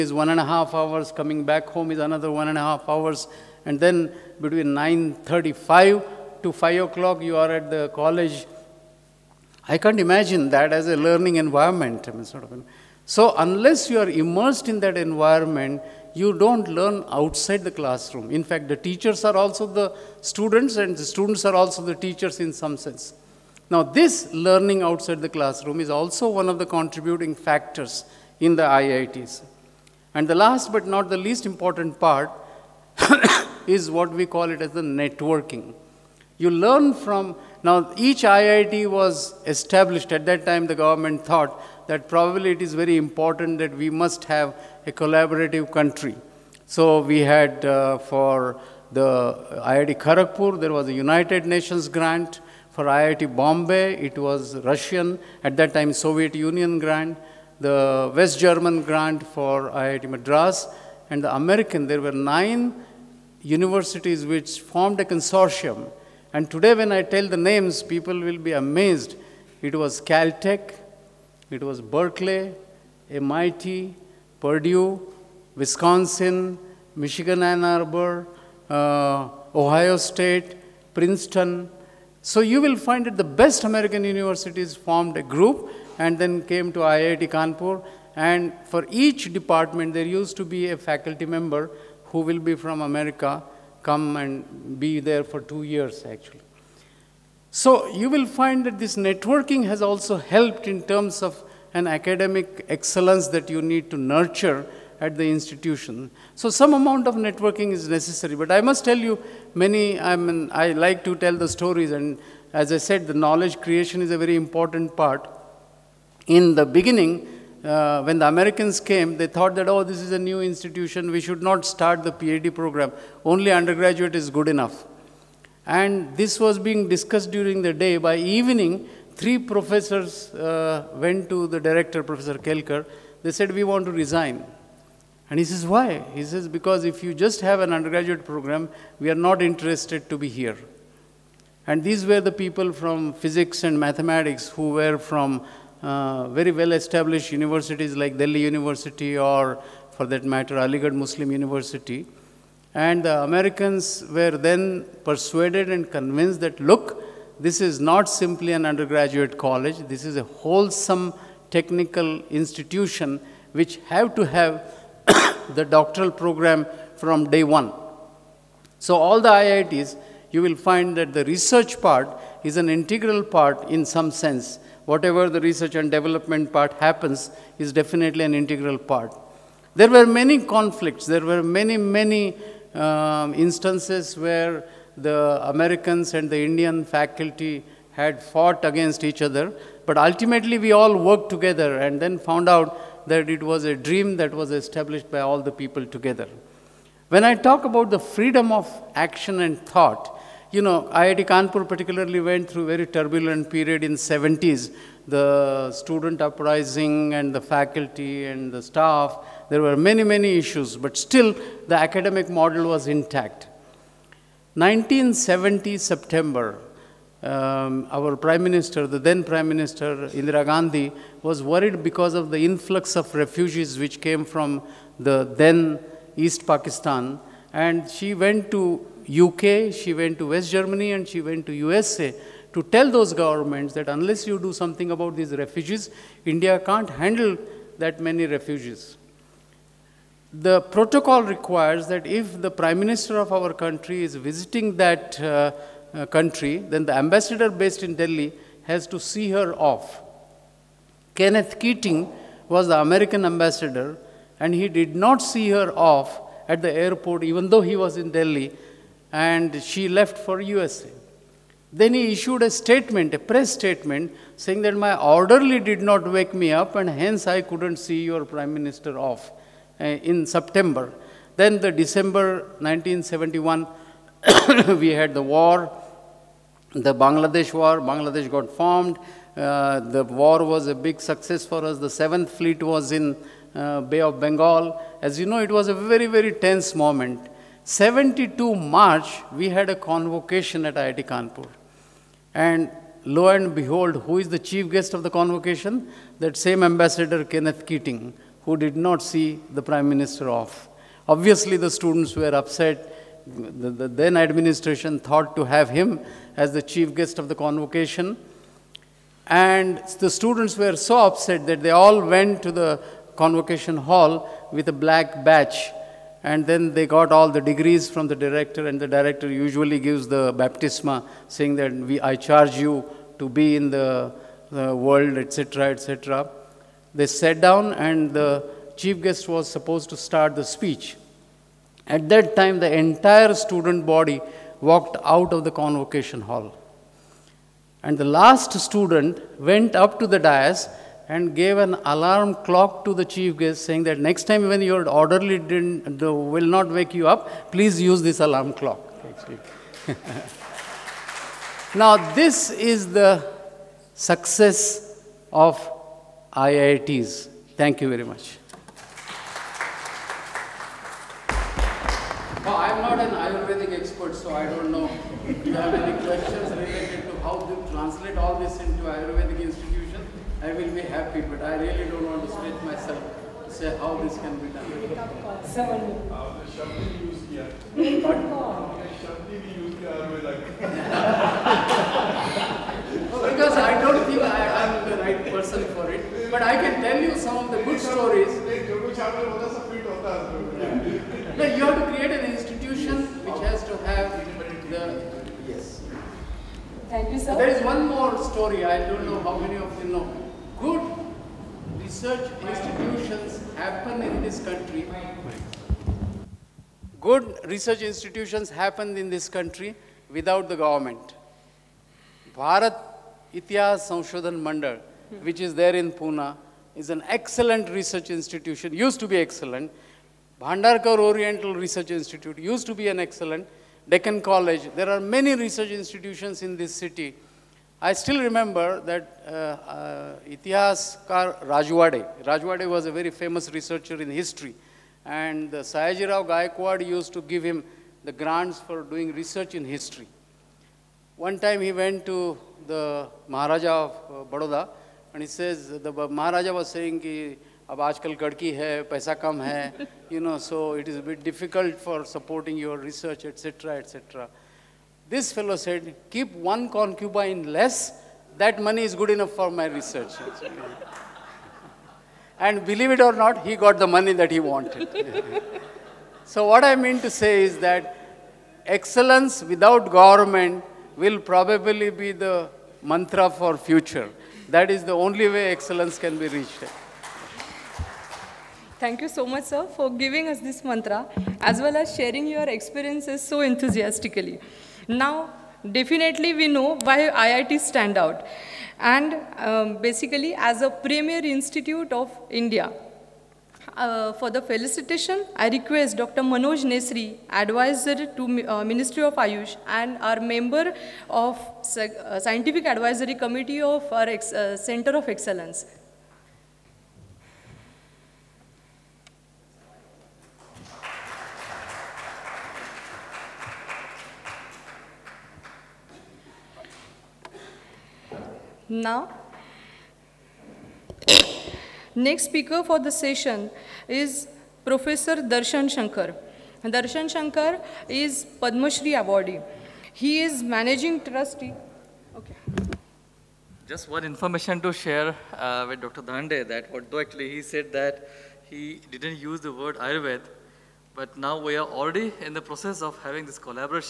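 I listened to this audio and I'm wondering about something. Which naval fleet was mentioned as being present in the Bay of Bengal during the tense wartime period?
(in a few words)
7th Fleet.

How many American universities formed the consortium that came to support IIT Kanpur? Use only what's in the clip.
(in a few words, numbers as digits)
9.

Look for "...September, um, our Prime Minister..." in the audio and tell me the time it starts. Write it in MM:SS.
03:35.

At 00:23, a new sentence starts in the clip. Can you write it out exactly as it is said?
Now this learning outside the classroom is also one of the contributing factors in the IITs.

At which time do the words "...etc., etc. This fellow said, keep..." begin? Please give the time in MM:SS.
07:33.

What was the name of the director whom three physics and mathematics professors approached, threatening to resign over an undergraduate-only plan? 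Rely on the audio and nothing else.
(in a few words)
Professor Kelkar.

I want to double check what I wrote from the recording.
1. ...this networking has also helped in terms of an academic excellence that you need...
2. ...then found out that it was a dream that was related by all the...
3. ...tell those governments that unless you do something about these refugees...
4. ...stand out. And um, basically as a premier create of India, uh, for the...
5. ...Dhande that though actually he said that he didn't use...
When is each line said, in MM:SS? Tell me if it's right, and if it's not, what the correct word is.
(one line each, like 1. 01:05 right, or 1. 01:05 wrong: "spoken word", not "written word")
1. 01:38 right
2. 03:12 wrong: "established", not "related"
3. 03:52 right
4. 08:07 wrong: "institute", not "create"
5. 08:56 wrong: "although", not "though".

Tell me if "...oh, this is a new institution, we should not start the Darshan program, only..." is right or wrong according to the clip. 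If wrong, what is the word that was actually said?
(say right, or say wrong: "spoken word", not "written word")
wrong: "PhD", not "Darshan".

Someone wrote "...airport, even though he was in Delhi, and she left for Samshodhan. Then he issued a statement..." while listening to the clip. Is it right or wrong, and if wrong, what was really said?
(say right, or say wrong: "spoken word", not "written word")
wrong: "USA", not "Samshodhan".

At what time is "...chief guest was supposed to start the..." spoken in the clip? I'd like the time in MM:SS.
05:28.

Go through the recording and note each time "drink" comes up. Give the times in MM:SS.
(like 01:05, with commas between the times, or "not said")
not said.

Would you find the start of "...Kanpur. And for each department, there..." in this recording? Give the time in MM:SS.
01:27.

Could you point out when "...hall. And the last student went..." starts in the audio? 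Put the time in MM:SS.
05:36.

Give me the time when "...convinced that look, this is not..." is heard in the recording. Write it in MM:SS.
02:35.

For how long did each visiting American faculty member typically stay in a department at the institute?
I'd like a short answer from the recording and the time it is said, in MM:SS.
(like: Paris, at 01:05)
2 years, at 01:35.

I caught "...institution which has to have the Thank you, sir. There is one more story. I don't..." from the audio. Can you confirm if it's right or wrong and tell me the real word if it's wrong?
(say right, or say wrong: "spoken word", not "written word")
right.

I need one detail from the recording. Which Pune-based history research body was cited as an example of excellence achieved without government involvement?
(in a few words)
Bharat Itihas Samshodhan Mandal.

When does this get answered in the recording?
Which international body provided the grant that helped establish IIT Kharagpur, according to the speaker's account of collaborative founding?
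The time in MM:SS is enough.
00:50.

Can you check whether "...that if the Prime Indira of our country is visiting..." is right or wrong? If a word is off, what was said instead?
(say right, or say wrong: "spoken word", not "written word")
wrong: "Minister", not "Indira".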